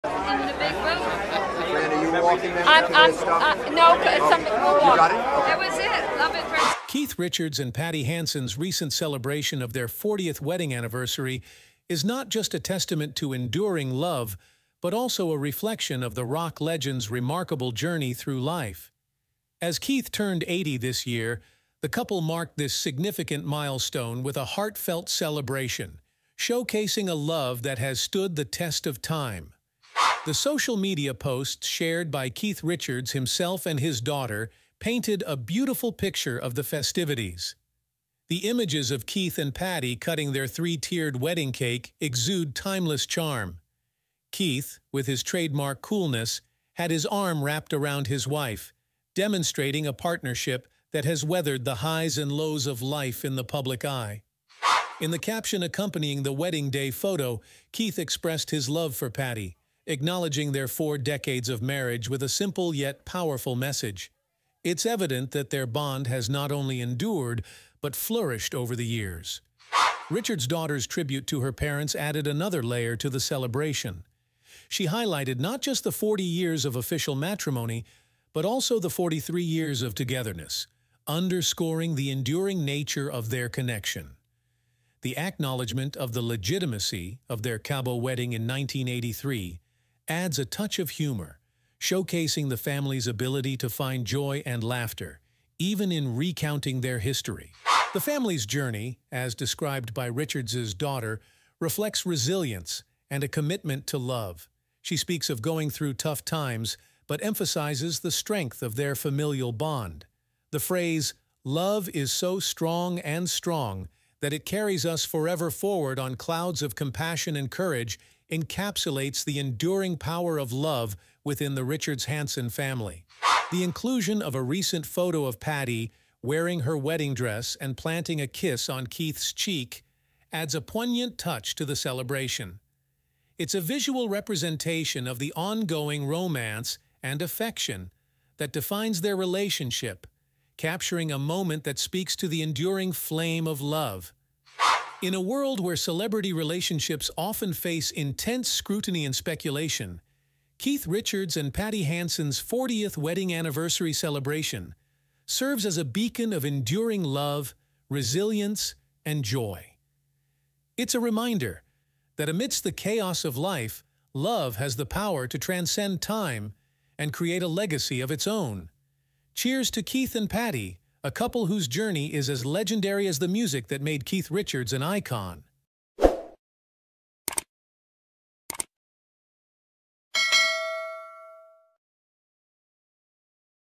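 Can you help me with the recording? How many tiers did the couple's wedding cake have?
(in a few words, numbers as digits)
3.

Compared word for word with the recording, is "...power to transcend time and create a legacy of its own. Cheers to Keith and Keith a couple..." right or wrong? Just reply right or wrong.
wrong.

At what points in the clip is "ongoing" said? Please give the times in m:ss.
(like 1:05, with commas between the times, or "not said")
2:15.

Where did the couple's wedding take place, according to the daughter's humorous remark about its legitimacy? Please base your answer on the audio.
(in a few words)
Cabo.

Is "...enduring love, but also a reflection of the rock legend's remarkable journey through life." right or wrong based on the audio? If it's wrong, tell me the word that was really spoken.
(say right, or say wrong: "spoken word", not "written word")
right.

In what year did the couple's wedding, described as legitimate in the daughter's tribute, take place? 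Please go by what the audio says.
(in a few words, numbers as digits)
1983.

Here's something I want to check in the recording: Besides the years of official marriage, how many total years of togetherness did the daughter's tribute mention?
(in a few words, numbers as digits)
43.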